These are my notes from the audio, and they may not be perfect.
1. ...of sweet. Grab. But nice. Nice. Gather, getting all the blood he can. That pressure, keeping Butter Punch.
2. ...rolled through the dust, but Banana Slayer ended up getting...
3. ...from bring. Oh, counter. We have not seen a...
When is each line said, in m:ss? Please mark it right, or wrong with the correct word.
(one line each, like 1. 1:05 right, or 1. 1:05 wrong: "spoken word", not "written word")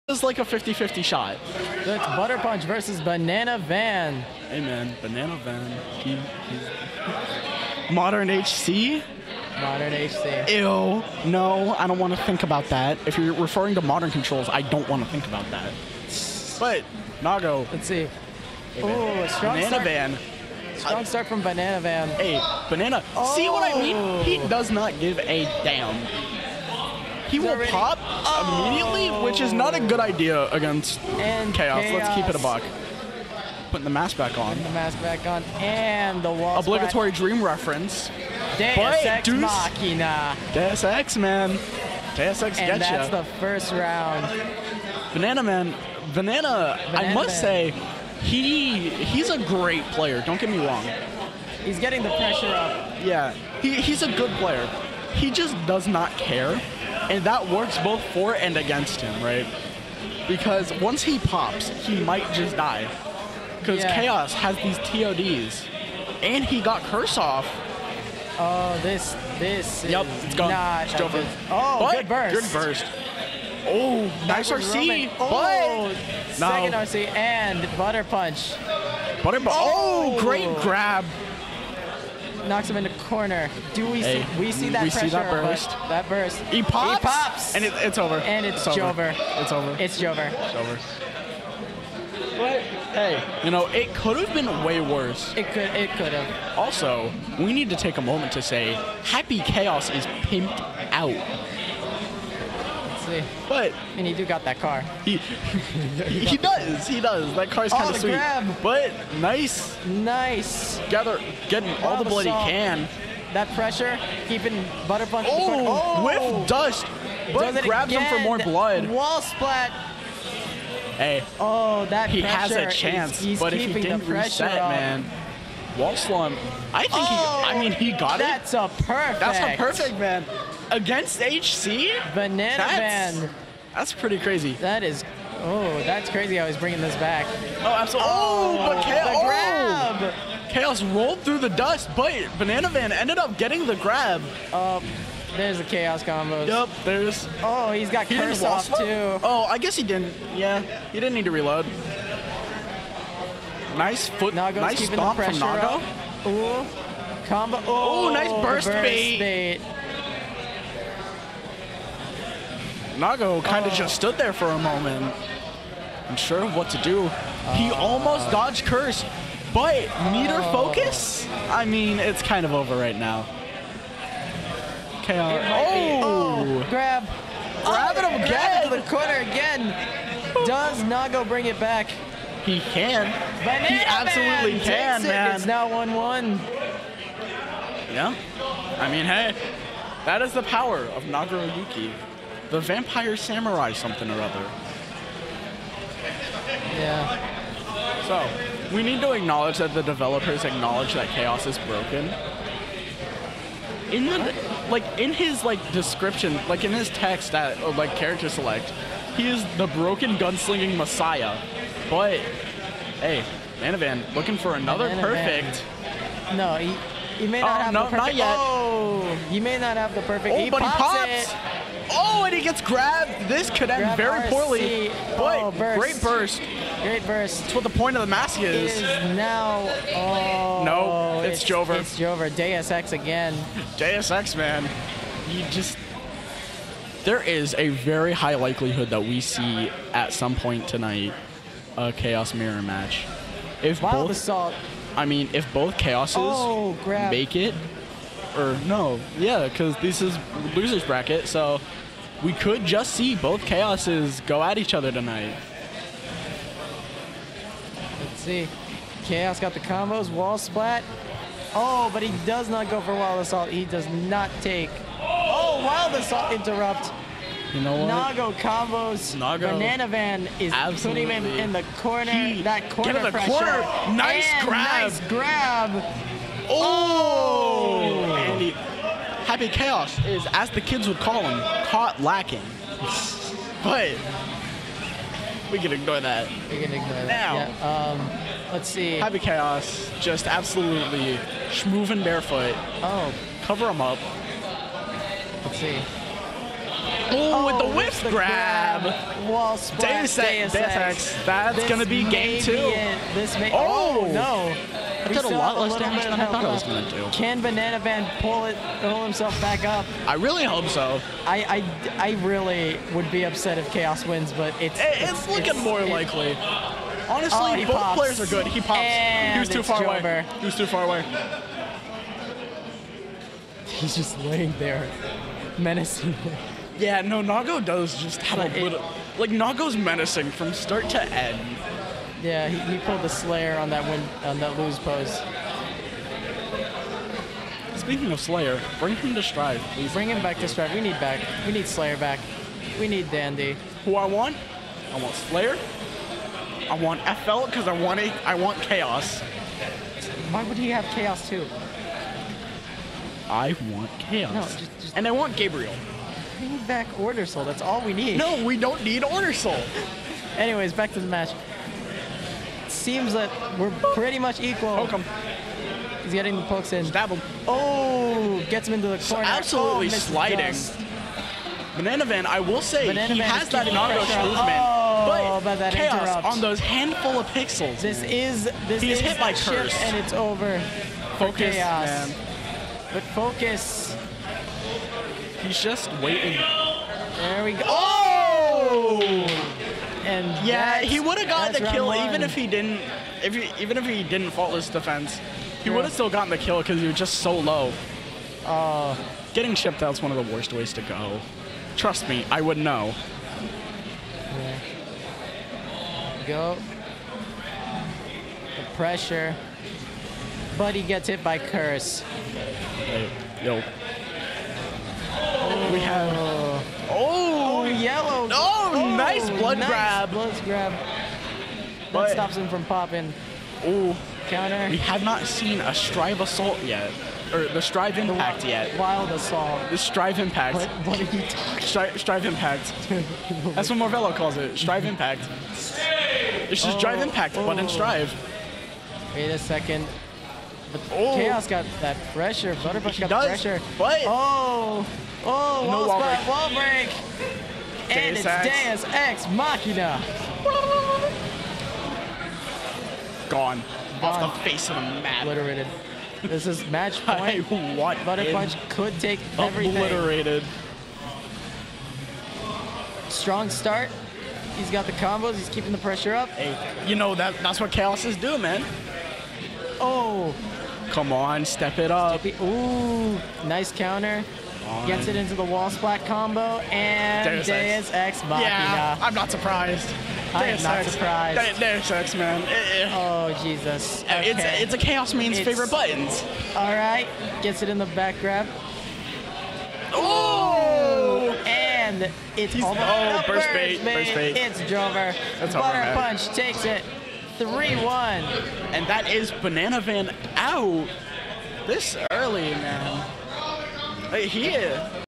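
1. 1:47 right
2. 2:20 wrong: "Man", not "Slayer"
3. 7:02 wrong: "popping", not "bring".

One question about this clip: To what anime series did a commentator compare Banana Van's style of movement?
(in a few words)
Naruto.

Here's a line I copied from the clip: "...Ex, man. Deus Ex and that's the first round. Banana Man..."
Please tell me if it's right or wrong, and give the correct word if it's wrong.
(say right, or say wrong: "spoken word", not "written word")
right.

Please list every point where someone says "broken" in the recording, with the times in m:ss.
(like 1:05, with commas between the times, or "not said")
3:21, 3:29.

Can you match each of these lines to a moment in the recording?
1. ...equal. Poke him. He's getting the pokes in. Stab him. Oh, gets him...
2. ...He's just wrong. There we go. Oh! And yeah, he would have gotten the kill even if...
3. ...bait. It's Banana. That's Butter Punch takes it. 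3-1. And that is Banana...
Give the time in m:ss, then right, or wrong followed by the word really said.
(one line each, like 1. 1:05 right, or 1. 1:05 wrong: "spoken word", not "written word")
1. 6:04 right
2. 6:25 wrong: "waiting", not "wrong"
3. 8:14 wrong: "Drover", not "Banana".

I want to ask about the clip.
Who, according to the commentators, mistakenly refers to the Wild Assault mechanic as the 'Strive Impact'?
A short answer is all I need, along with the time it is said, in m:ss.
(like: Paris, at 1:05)
Morvello, at 7:13.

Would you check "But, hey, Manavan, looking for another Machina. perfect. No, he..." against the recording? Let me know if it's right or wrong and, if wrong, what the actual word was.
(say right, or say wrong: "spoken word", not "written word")
wrong: "Manavan", not "Machina".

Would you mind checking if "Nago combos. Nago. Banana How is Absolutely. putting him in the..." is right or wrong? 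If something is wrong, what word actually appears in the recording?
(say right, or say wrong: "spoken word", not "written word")
wrong: "Van", not "How".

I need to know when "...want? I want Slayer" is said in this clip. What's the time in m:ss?
5:44.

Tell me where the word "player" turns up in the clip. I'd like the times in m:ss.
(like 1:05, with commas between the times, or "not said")
0:49, 0:54, 5:17.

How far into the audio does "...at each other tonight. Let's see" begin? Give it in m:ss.
4:14.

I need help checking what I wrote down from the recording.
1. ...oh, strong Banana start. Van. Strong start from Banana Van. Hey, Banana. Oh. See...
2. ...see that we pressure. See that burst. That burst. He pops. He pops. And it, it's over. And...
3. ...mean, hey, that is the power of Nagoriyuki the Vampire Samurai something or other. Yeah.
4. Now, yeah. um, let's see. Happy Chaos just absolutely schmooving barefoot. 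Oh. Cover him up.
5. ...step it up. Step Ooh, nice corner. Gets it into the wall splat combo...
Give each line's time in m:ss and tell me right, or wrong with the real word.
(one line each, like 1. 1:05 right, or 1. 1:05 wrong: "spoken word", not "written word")
1. 0:18 right
2. 1:24 right
3. 3:08 right
4. 4:47 right
5. 7:51 wrong: "counter", not "corner".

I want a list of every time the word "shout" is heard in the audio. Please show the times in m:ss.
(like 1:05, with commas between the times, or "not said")
not said.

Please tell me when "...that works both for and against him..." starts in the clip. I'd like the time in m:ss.
0:57.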